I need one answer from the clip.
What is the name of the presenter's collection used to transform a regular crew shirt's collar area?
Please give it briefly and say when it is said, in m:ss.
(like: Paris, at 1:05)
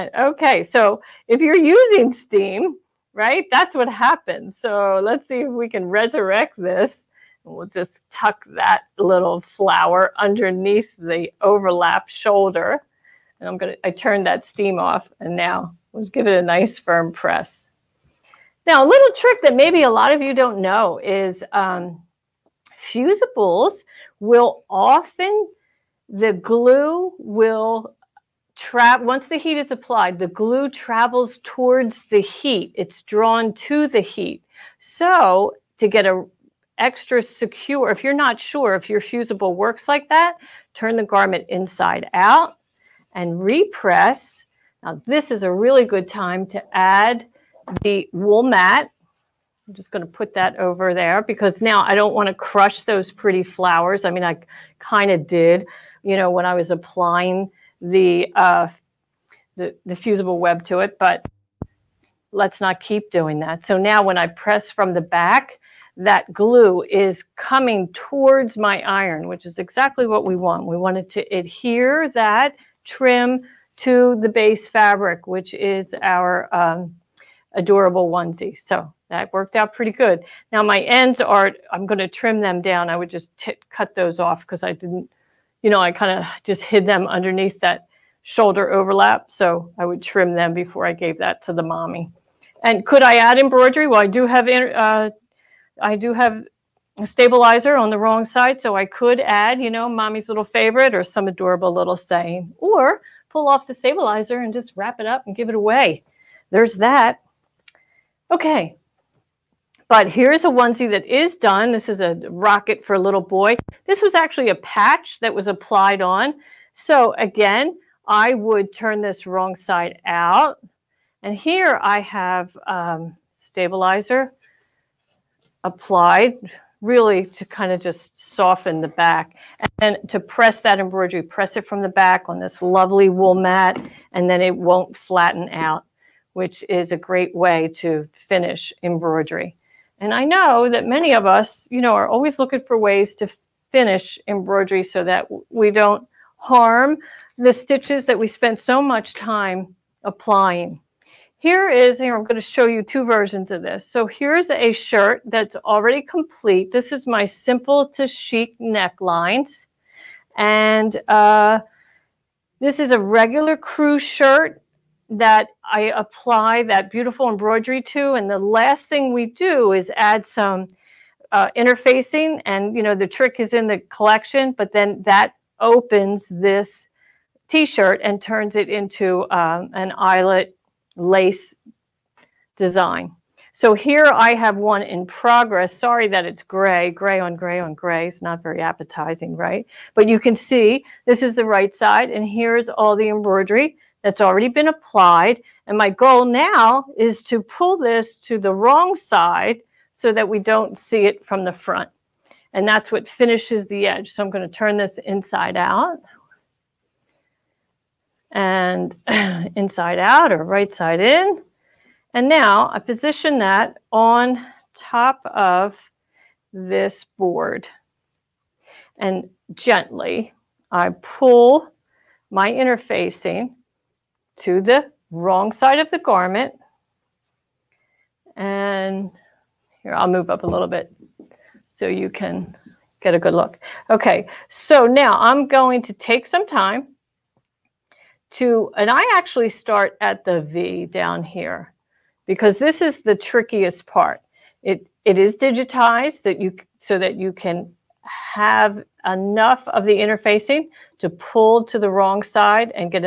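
simple to chic necklines, at 2:37.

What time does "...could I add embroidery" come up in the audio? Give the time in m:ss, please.
1:32.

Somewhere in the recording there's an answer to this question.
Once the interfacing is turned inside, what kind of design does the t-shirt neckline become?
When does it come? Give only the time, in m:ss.
2:59.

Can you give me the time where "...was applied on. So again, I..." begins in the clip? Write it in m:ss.
1:55.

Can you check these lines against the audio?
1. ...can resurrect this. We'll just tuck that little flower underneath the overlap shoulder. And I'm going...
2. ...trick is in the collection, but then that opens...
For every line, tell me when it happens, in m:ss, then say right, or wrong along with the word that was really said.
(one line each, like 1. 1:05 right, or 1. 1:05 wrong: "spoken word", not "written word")
1. 0:05 right
2. 2:53 right.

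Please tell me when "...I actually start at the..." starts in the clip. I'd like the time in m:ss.
3:58.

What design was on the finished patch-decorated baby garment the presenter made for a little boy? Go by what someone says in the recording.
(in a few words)
a rocket.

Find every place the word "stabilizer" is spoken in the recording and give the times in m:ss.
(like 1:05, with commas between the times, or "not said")
1:37, 1:43, 2:03.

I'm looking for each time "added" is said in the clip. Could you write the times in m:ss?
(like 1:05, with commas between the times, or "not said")
not said.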